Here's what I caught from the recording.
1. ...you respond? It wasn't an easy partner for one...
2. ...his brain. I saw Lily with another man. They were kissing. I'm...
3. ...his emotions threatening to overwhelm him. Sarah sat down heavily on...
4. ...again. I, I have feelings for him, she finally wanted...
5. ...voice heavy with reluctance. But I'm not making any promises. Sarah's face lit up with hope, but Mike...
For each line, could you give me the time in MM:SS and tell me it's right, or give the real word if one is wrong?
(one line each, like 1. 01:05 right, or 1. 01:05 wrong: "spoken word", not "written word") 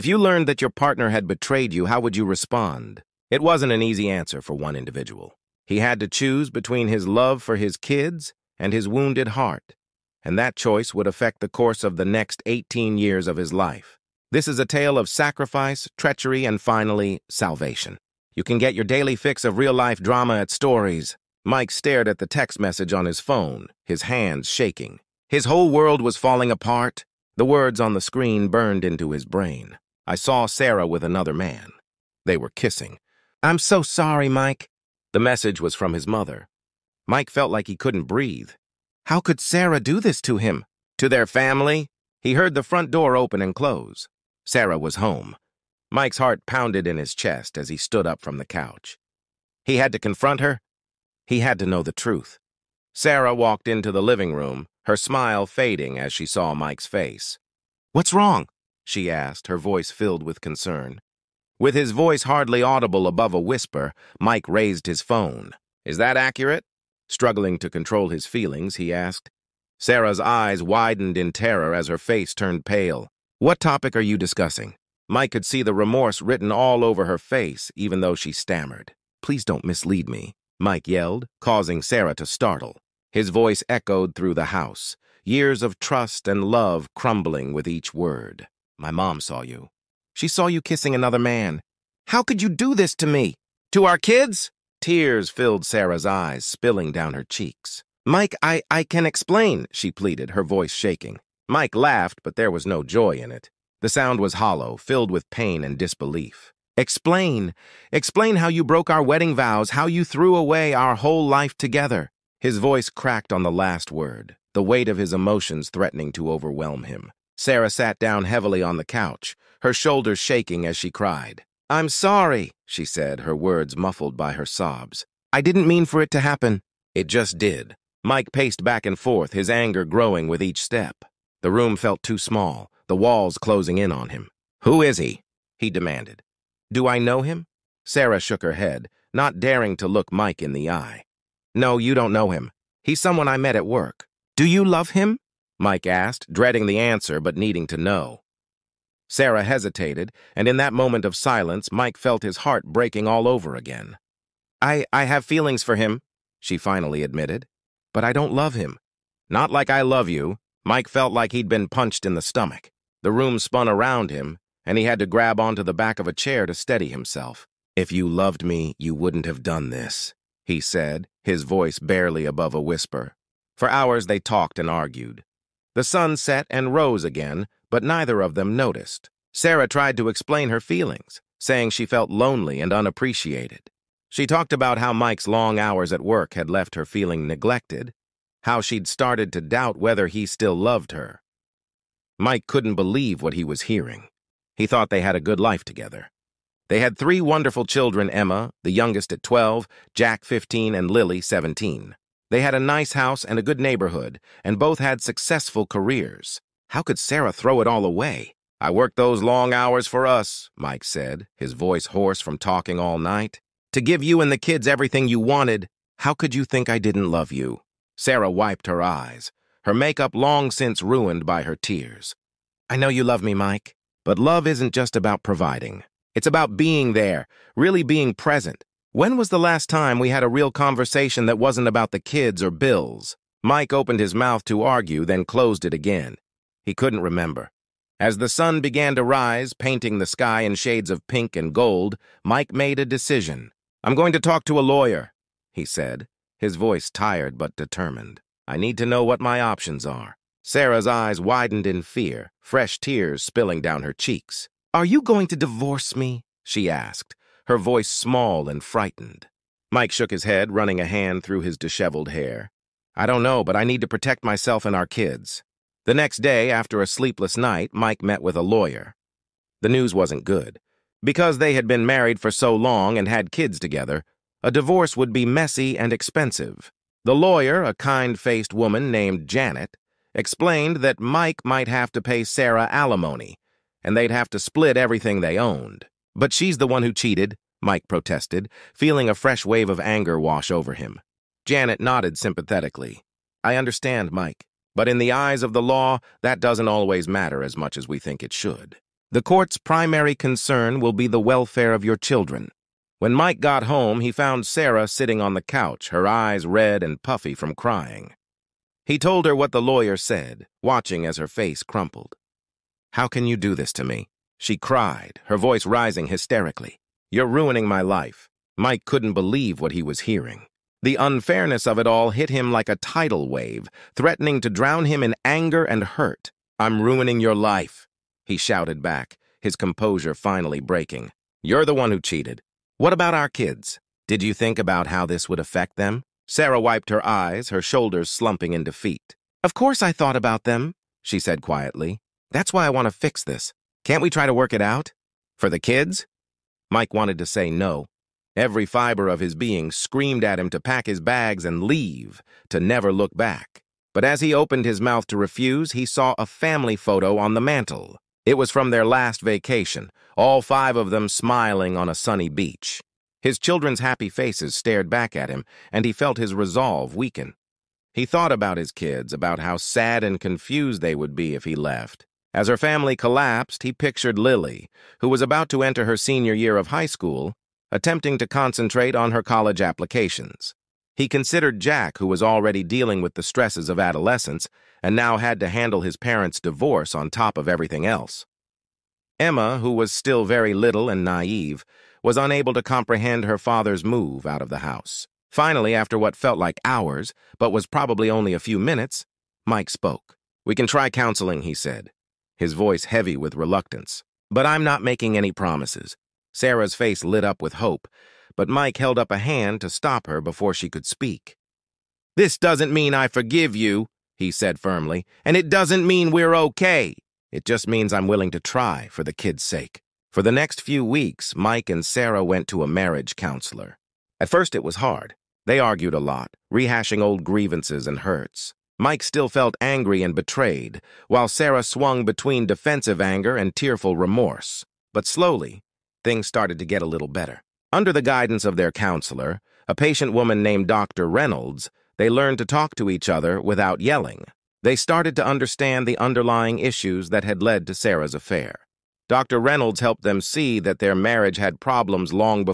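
1. 00:02 wrong: "answer", not "partner"
2. 00:29 wrong: "Sarah", not "Lily"
3. 01:54 right
4. 02:33 wrong: "admitted", not "wanted"
5. 06:42 right.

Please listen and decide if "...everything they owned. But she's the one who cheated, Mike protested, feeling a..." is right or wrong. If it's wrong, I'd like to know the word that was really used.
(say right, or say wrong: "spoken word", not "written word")
right.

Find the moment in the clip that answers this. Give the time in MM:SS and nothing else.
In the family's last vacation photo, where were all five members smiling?
06:01.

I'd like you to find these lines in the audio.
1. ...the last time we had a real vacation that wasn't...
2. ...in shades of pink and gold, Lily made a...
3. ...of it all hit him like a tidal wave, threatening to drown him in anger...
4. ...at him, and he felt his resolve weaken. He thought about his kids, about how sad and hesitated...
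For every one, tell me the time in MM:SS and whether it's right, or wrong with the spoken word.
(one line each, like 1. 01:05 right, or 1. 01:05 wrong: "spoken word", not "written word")
1. 03:49 wrong: "conversation", not "vacation"
2. 04:00 wrong: "Mike", not "Lily"
3. 05:21 right
4. 06:05 wrong: "confused", not "hesitated".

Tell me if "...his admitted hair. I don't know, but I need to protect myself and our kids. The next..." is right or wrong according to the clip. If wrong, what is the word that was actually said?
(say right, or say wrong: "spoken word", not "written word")
wrong: "disheveled", not "admitted".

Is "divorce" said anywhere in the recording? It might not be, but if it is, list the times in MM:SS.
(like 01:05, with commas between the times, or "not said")
04:15, 04:34, 06:26.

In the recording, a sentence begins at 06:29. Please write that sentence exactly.
Emma, who was still very little and naive, was unable to comprehend her father's move out of the house.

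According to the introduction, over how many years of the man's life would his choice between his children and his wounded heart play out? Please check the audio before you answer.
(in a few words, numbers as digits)
18.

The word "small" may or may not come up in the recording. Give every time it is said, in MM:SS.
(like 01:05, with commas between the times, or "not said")
02:12, 04:17.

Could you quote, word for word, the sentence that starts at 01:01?
With his voice hardly audible above a whisper, Mike raised his phone.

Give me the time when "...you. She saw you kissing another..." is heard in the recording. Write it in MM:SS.
01:29.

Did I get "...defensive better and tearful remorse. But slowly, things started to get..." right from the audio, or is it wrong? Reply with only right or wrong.
wrong.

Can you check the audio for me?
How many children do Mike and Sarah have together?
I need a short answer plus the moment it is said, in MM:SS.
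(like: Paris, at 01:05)
3, at 03:16.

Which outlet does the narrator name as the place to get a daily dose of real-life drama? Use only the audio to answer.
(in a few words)
Stories.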